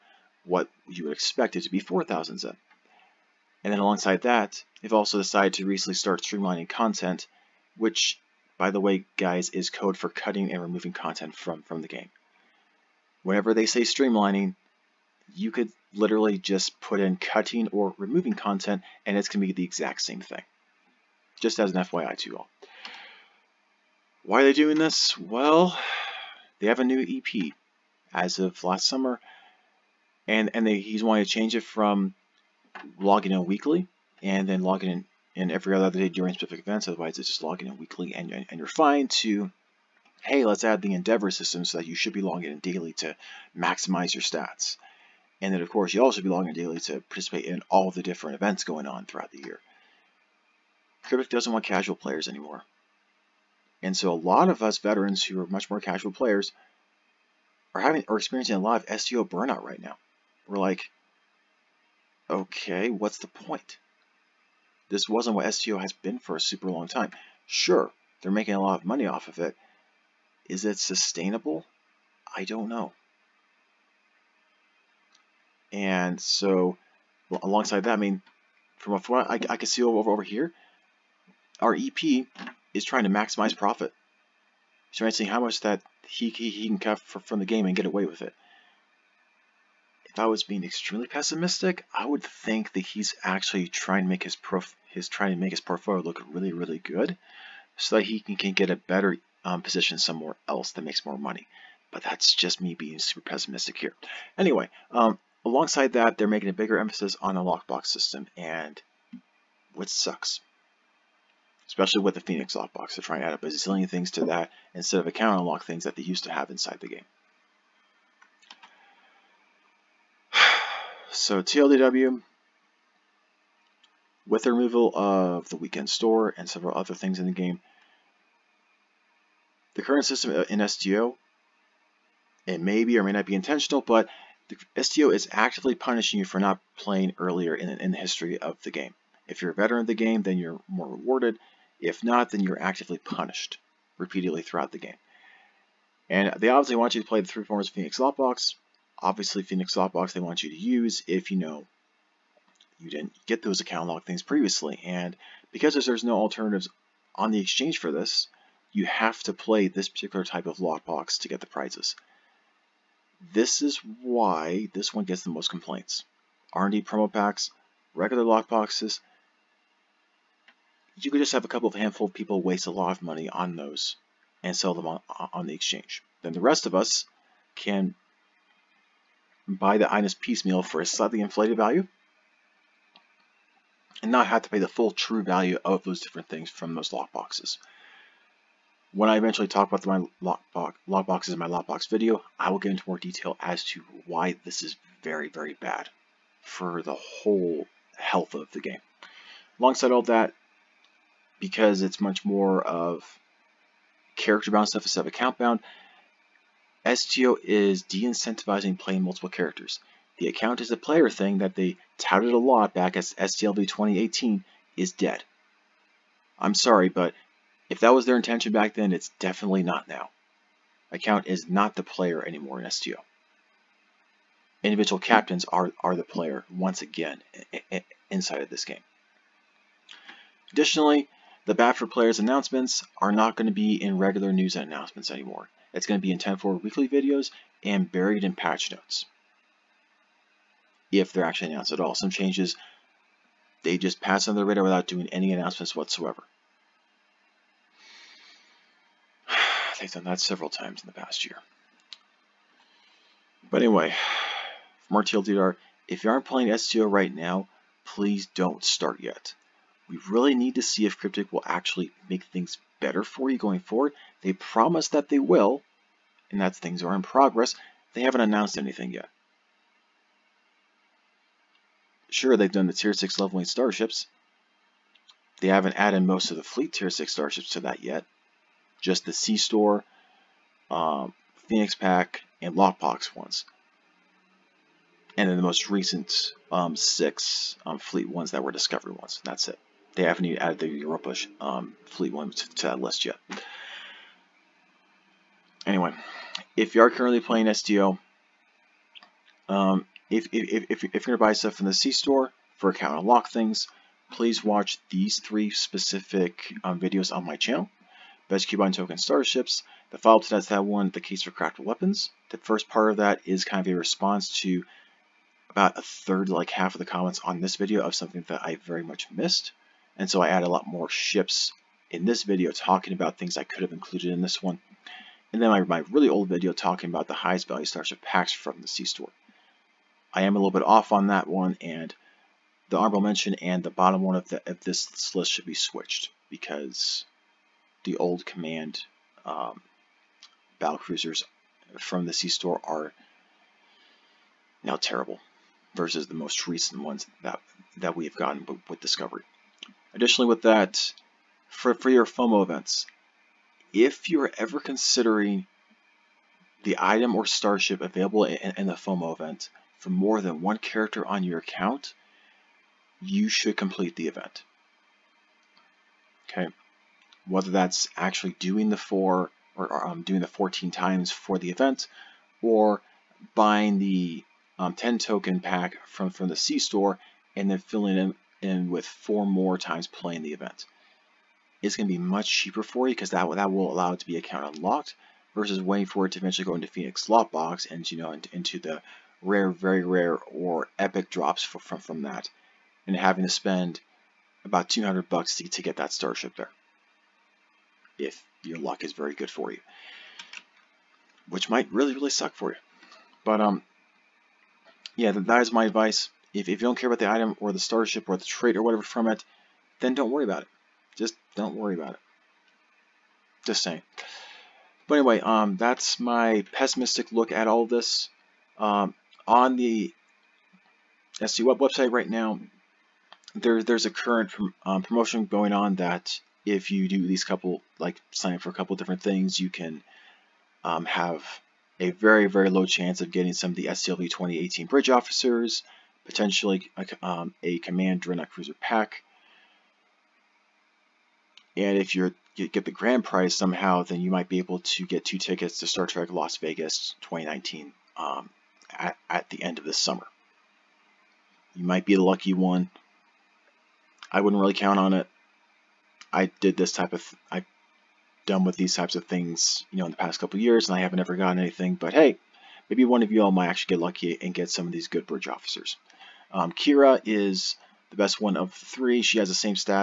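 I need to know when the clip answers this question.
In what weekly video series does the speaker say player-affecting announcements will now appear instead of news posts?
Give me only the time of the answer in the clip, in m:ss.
3:56.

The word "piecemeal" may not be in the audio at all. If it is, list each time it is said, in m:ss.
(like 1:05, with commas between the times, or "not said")
3:00.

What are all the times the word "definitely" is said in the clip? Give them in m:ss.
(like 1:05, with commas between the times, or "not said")
3:39.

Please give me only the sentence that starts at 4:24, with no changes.
They promise that they will, and that things are in progress.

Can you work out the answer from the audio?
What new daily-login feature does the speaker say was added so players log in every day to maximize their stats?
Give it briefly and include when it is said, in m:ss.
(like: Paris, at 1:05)
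Endeavor system, at 0:40.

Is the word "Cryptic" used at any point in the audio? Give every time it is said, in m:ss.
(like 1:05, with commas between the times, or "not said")
0:51, 4:20.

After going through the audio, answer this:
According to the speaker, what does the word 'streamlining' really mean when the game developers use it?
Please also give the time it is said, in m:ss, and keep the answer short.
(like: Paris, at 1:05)
cutting or removing content, at 0:17.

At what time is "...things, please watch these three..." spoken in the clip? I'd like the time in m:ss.
5:03.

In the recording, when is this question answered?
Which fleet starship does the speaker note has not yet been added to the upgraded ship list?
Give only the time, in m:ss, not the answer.
4:50.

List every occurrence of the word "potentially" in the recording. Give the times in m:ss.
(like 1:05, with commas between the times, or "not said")
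7:16.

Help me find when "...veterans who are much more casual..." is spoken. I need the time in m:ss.
0:54.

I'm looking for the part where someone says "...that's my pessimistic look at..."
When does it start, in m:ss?
6:55.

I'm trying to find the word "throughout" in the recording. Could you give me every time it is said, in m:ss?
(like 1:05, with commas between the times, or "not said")
0:49, 2:24.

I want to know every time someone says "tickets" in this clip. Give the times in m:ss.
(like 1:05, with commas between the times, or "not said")
7:25.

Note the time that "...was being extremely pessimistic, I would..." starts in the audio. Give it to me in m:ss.
1:30.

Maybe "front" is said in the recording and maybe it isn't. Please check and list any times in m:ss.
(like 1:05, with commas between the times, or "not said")
not said.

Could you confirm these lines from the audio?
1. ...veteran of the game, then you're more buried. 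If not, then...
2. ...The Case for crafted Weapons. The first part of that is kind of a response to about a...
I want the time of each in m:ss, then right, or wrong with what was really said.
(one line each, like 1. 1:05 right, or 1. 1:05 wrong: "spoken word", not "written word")
1. 2:19 wrong: "rewarded", not "buried"
2. 5:10 right.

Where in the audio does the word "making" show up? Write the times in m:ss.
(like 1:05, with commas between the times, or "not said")
1:08, 1:46.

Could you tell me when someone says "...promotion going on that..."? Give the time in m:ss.
7:04.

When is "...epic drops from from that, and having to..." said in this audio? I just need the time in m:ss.
6:30.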